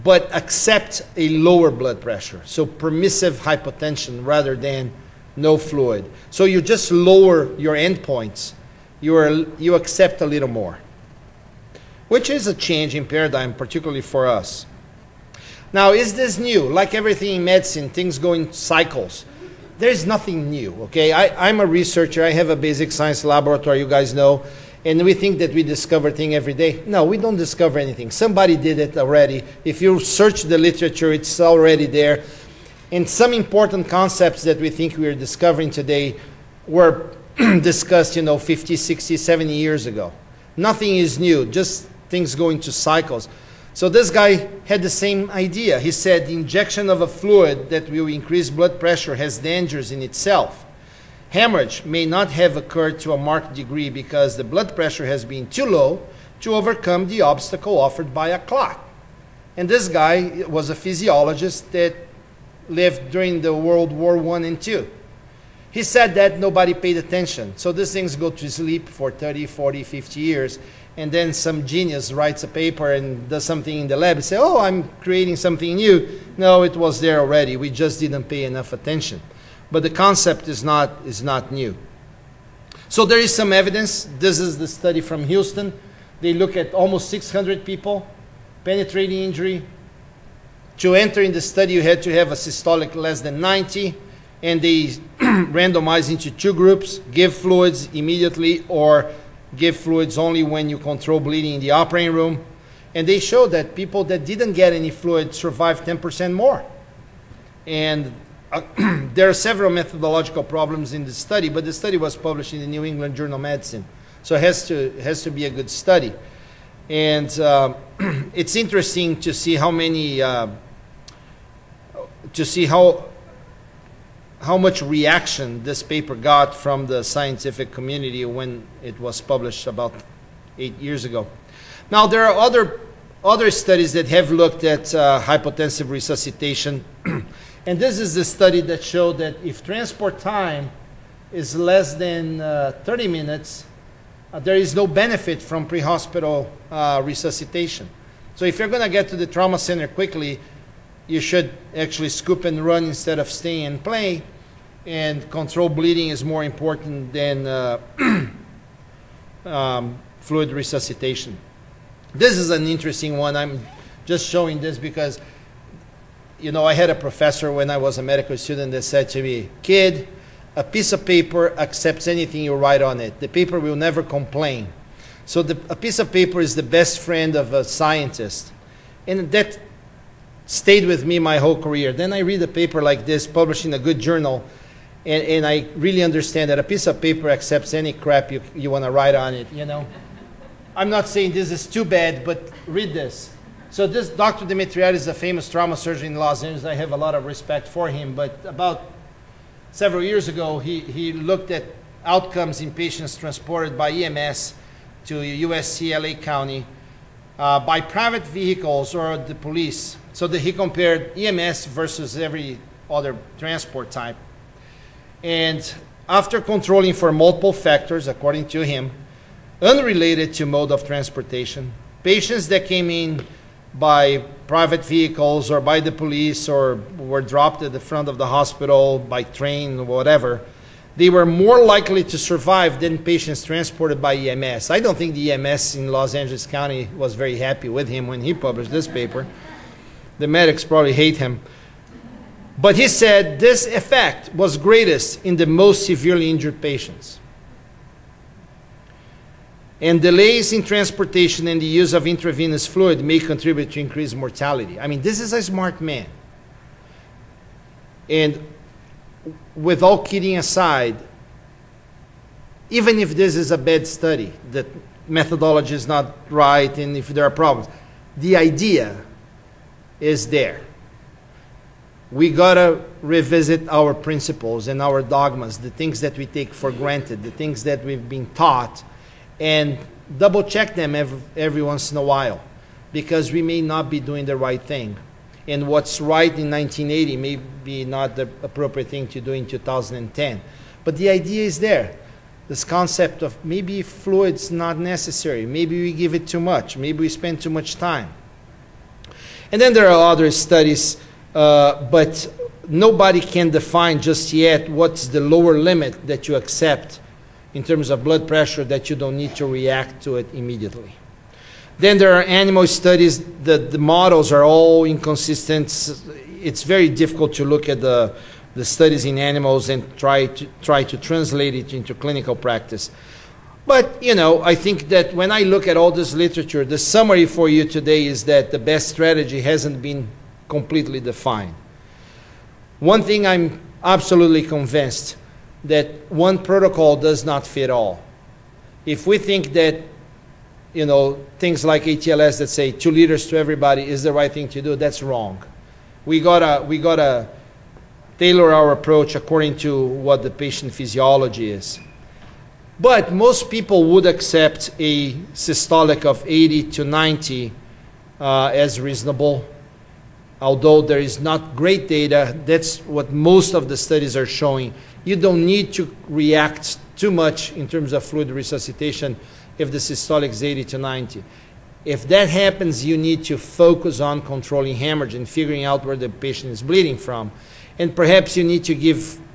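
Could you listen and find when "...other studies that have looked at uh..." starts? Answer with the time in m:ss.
2:13.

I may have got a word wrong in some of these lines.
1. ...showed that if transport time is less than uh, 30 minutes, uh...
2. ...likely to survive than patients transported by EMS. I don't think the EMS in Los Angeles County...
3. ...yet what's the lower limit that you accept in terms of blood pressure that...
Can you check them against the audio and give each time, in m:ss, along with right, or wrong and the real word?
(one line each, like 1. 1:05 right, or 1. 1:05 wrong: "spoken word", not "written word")
1. 2:18 right
2. 3:51 right
3. 5:04 right.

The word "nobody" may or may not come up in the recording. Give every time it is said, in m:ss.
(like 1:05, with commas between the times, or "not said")
1:06, 5:02.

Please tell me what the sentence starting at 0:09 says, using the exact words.
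You, are, you accept a little more, which is a change in paradigm, particularly for us.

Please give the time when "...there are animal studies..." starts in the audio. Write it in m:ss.
5:11.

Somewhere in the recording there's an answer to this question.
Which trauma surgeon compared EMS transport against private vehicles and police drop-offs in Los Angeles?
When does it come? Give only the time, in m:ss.
3:14.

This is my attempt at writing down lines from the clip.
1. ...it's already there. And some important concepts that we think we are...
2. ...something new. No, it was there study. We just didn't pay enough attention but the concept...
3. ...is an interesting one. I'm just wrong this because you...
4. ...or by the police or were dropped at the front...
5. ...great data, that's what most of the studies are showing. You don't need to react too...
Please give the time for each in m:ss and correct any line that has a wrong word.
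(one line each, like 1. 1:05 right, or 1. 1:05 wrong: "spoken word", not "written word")
1. 0:31 right
2. 1:15 wrong: "already", not "study"
3. 2:42 wrong: "showing", not "wrong"
4. 3:45 right
5. 6:01 right.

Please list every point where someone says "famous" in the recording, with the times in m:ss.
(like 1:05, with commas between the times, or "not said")
3:15.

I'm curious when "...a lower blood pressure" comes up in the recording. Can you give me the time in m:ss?
0:01.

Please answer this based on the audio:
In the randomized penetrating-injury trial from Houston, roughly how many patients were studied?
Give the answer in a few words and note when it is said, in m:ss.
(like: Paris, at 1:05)
600, at 1:26.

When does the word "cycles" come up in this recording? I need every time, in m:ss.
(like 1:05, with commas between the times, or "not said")
0:18, 0:42.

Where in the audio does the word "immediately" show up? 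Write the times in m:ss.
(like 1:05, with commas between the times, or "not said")
1:37, 5:10.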